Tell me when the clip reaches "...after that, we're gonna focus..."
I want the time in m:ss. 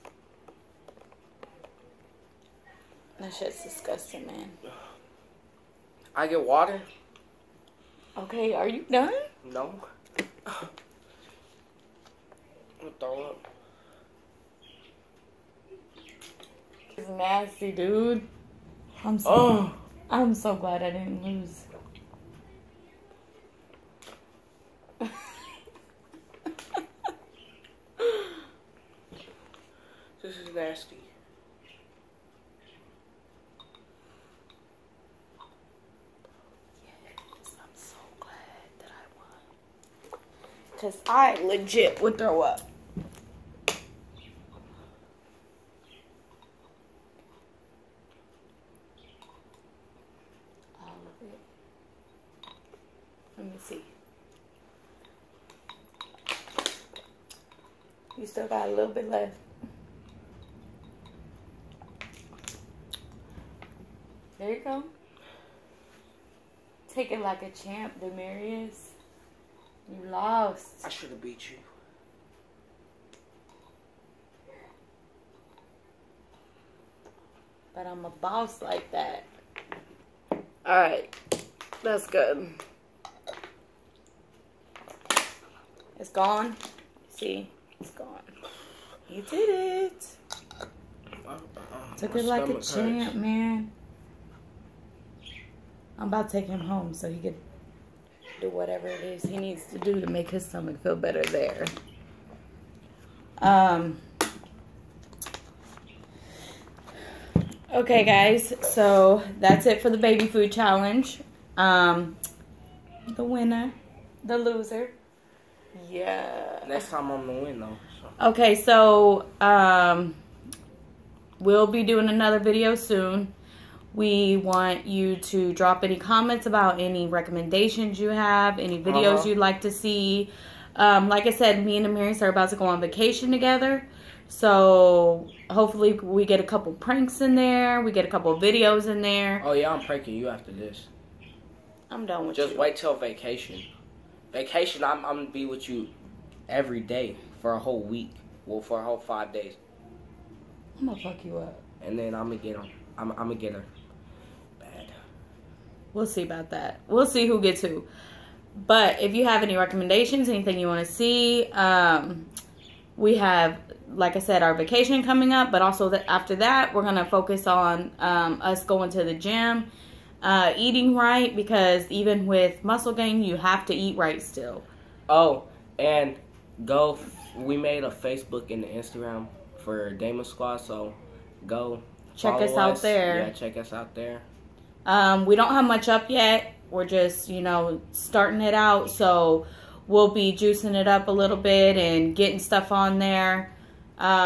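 2:46.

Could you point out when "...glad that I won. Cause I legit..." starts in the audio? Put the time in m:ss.
0:38.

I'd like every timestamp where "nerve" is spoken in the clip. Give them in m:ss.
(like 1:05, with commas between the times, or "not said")
not said.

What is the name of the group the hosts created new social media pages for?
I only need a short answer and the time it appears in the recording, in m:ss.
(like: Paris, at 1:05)
Dama Squad, at 2:59.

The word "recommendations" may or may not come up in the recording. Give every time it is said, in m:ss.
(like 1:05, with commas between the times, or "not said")
2:07, 2:39.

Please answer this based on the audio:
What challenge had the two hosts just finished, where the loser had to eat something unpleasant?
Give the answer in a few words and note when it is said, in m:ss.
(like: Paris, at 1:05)
baby food challenge, at 1:49.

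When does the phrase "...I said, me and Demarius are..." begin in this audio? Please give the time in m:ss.
2:11.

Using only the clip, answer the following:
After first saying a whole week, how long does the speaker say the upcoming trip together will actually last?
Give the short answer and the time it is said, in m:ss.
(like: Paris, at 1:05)
5 days, at 2:28.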